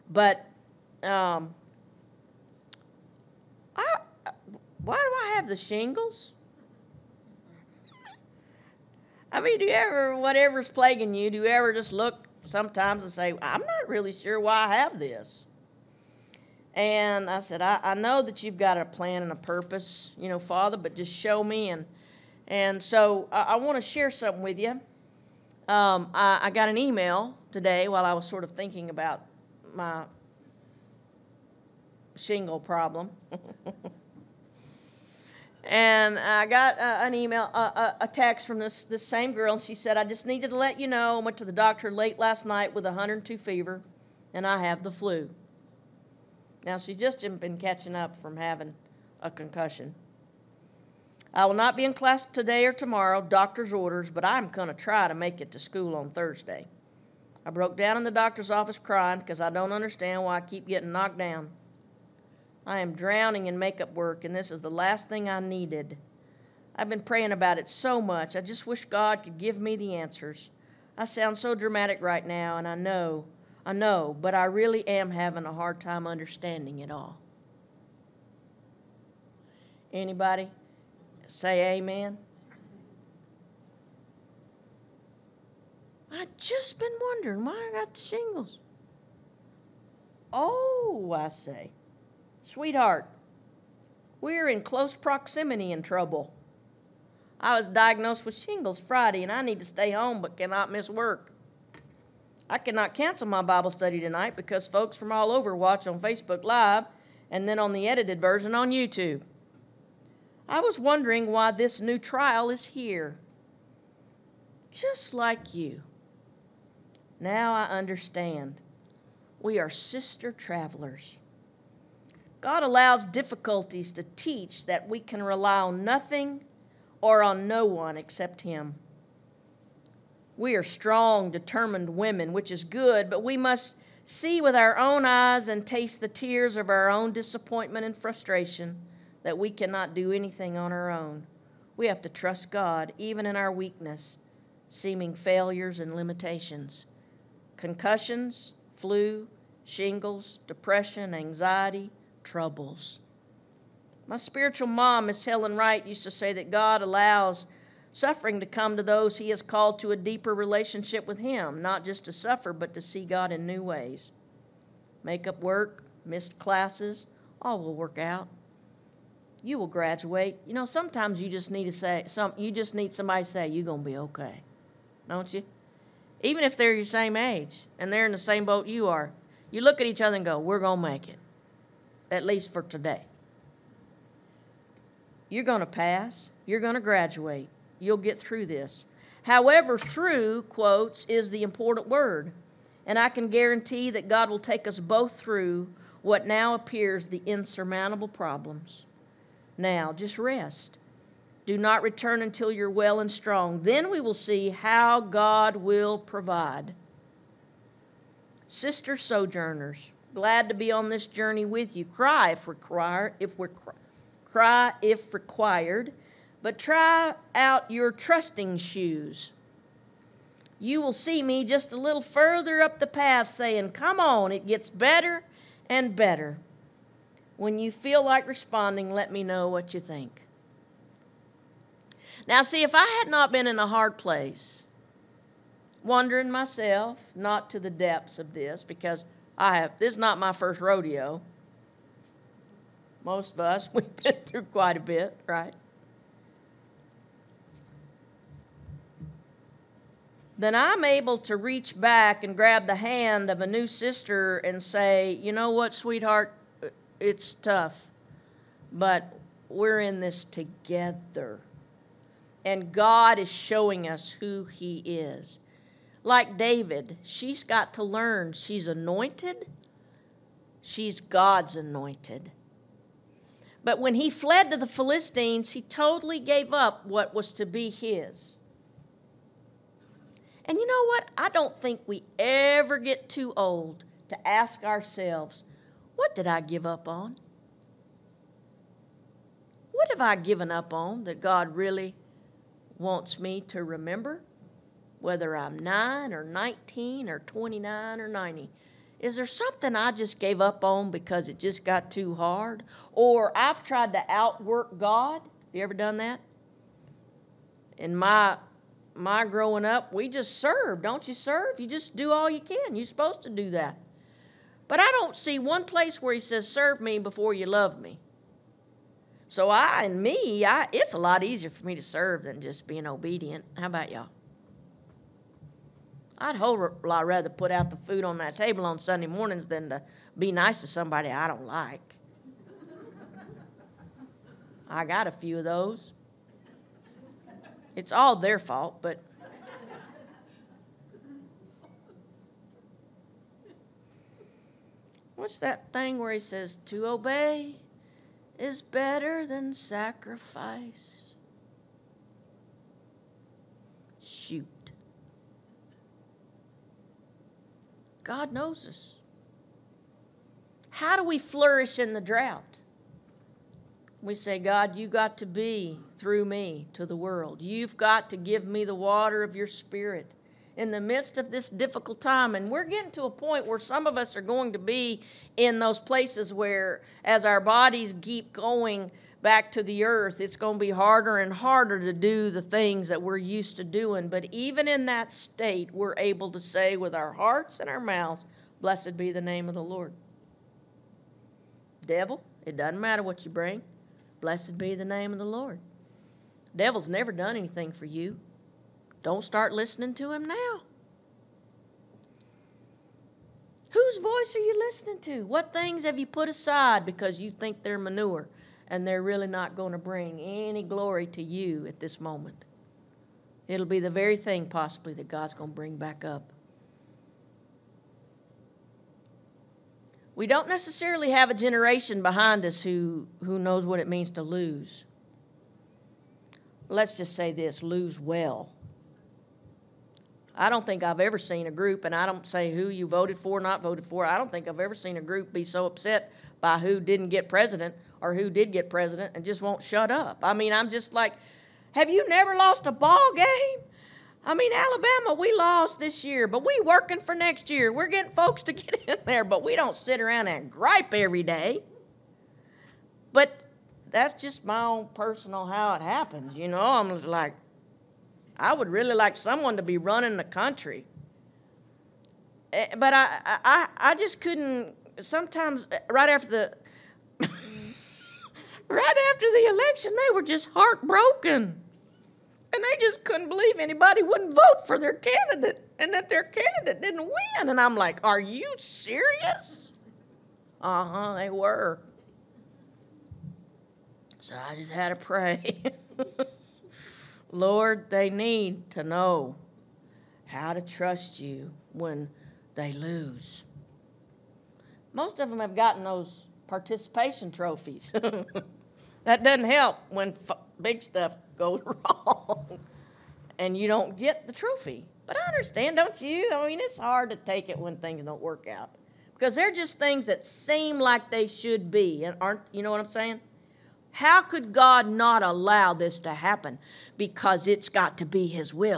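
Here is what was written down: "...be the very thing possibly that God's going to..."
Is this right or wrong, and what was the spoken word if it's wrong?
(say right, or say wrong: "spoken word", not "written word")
right.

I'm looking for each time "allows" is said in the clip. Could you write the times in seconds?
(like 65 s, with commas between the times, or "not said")
122 s, 156 s, 515 s.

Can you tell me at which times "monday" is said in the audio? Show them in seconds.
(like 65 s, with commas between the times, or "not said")
not said.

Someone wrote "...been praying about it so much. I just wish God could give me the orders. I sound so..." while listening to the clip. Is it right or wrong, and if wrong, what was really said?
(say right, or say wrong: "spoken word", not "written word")
wrong: "answers", not "orders".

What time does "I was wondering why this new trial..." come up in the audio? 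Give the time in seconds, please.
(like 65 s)
110 s.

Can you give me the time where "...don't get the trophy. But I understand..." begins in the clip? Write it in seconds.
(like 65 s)
503 s.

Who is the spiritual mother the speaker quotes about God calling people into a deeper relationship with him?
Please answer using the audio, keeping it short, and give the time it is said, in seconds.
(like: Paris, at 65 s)
Miss Helen Wright, at 155 s.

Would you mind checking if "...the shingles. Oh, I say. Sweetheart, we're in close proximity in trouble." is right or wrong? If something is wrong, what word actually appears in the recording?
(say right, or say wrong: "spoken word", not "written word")
right.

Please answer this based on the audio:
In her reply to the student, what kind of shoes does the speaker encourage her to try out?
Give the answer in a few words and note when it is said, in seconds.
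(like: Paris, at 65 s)
trusting shoes, at 217 s.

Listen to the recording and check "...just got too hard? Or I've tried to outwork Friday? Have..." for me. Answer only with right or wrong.
wrong.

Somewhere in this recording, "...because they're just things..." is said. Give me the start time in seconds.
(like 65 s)
509 s.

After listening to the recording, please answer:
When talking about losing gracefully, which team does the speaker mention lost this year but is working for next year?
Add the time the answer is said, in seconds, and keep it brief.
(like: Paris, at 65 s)
Alabama, at 444 s.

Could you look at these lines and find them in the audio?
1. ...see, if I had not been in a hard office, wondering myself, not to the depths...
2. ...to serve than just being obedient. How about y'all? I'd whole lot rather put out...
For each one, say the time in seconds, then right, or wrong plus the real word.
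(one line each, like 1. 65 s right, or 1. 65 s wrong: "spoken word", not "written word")
1. 232 s wrong: "place", not "office"
2. 321 s right.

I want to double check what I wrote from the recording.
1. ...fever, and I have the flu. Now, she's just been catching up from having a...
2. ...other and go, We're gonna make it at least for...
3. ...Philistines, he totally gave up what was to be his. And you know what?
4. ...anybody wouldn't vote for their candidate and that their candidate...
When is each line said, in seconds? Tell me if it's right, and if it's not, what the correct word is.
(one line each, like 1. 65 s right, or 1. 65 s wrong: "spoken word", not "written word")
1. 43 s right
2. 180 s right
3. 274 s right
4. 473 s right.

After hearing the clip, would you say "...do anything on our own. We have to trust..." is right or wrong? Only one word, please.
right.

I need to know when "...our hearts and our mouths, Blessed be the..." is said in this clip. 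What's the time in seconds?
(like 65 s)
386 s.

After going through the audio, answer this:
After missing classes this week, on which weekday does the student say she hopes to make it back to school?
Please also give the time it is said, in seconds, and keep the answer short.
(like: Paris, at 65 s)
Thursday, at 56 s.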